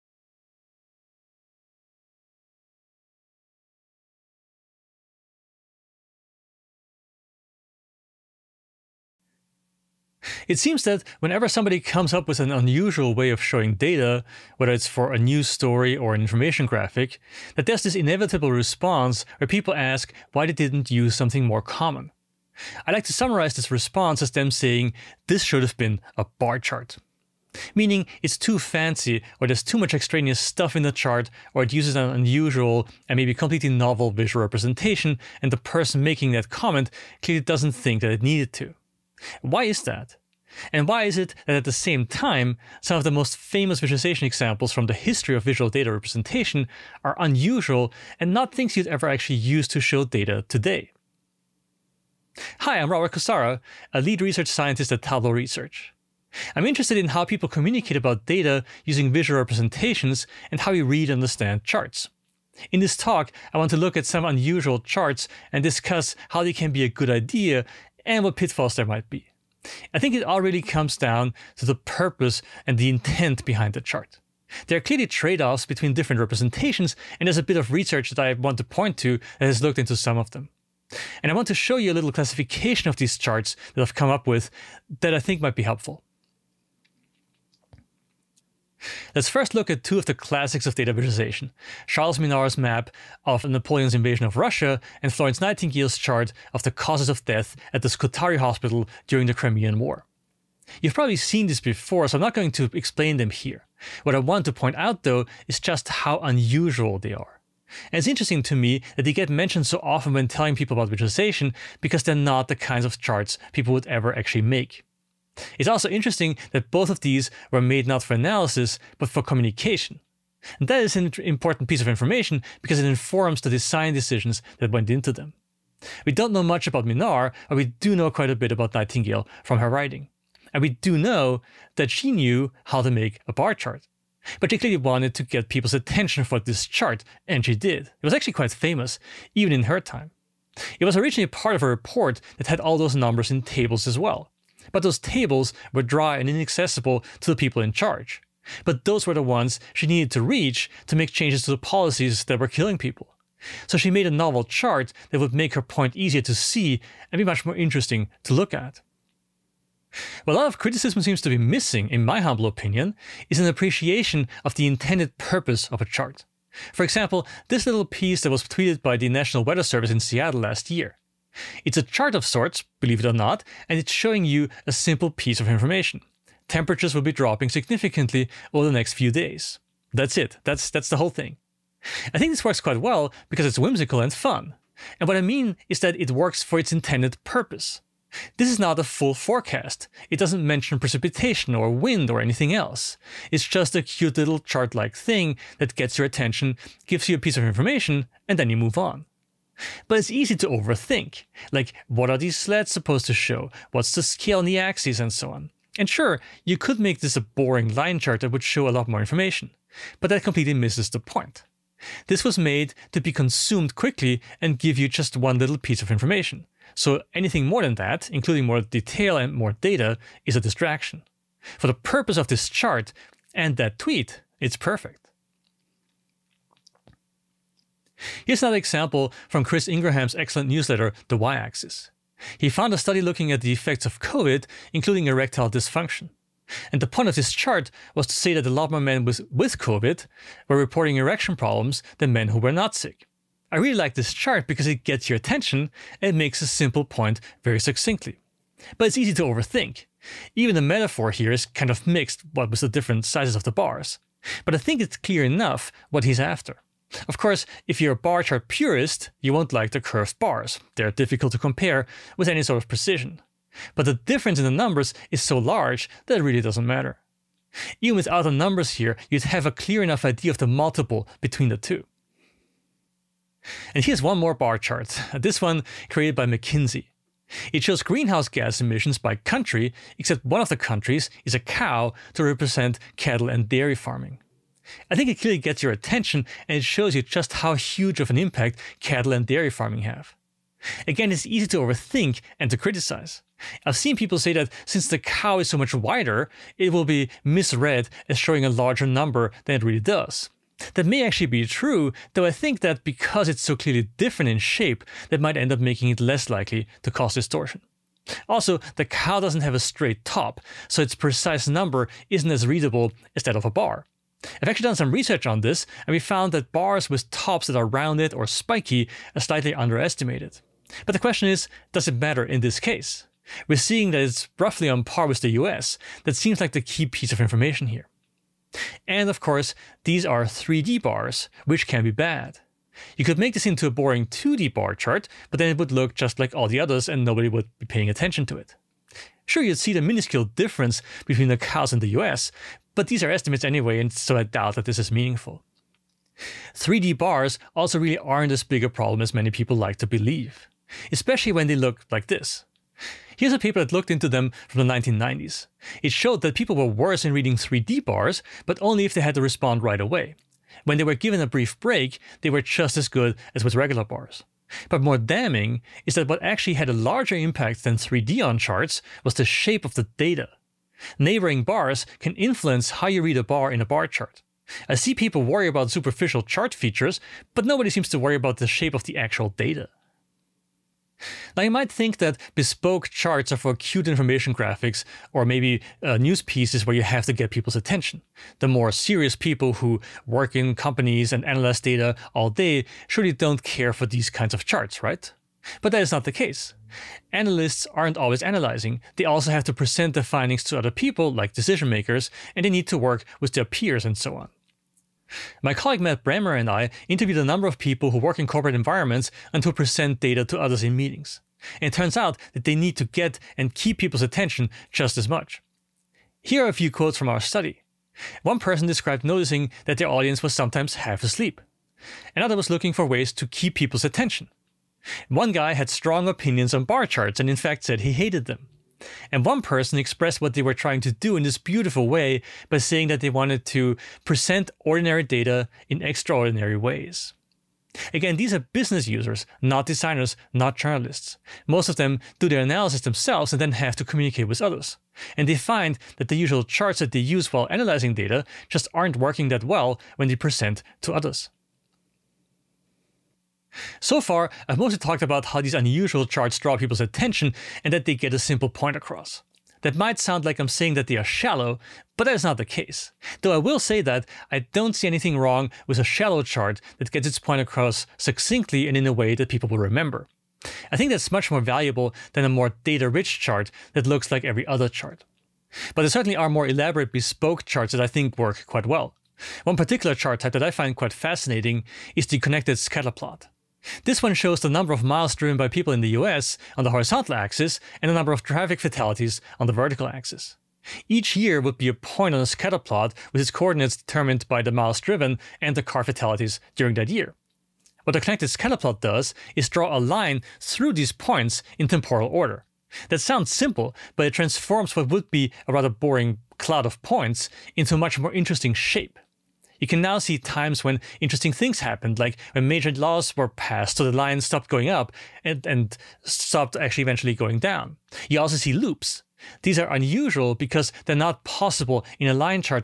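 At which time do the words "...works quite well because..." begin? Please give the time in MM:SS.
03:02.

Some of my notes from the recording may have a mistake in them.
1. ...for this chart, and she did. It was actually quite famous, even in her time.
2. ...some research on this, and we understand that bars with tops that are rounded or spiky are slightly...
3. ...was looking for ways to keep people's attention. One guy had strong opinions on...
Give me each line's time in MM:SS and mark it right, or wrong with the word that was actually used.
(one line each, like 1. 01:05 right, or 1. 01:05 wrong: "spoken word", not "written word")
1. 02:16 right
2. 05:14 wrong: "found", not "understand"
3. 07:02 right.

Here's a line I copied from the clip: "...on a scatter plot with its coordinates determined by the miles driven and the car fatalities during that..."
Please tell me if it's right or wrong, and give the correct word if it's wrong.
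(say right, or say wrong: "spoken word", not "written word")
right.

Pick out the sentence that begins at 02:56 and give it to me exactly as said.
Temperatures will be dropping significantly over the next few days.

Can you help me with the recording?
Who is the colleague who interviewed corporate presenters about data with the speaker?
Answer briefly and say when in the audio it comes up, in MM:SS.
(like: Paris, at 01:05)
Matt Brehmer, at 06:45.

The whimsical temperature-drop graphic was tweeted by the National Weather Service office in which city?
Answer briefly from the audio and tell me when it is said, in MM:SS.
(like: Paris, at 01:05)
Seattle, at 02:49.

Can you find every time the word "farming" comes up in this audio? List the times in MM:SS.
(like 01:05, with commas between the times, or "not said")
04:43, 04:49.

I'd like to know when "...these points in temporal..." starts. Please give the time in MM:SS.
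08:20.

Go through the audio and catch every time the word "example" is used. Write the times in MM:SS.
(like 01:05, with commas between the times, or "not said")
00:44, 02:46, 03:48.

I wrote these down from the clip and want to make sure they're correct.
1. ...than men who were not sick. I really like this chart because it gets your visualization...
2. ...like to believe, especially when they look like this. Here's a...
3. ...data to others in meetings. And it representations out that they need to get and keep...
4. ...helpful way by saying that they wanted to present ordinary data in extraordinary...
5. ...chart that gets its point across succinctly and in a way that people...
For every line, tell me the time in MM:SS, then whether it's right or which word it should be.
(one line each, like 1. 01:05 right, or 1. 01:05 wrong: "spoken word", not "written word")
1. 04:01 wrong: "attention", not "visualization"
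2. 05:49 right
3. 06:49 wrong: "turns", not "representations"
4. 07:11 wrong: "beautiful", not "helpful"
5. 07:46 right.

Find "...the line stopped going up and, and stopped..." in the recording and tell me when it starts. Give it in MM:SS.
08:33.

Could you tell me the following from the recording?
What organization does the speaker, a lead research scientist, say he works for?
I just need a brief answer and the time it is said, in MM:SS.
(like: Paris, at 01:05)
Tableau Research, at 00:55.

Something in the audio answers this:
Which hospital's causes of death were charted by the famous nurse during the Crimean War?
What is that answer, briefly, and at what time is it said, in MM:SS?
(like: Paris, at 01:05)
Scutari Hospital, at 01:37.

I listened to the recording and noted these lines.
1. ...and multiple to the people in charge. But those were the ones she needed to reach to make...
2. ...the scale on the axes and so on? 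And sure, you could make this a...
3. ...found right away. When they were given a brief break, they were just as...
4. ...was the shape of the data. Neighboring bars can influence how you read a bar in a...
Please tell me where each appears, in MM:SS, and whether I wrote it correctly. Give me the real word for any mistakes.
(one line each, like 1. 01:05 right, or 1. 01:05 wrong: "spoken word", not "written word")
1. 02:26 wrong: "inaccessible", not "multiple"
2. 03:23 right
3. 05:59 wrong: "respond", not "found"
4. 06:09 right.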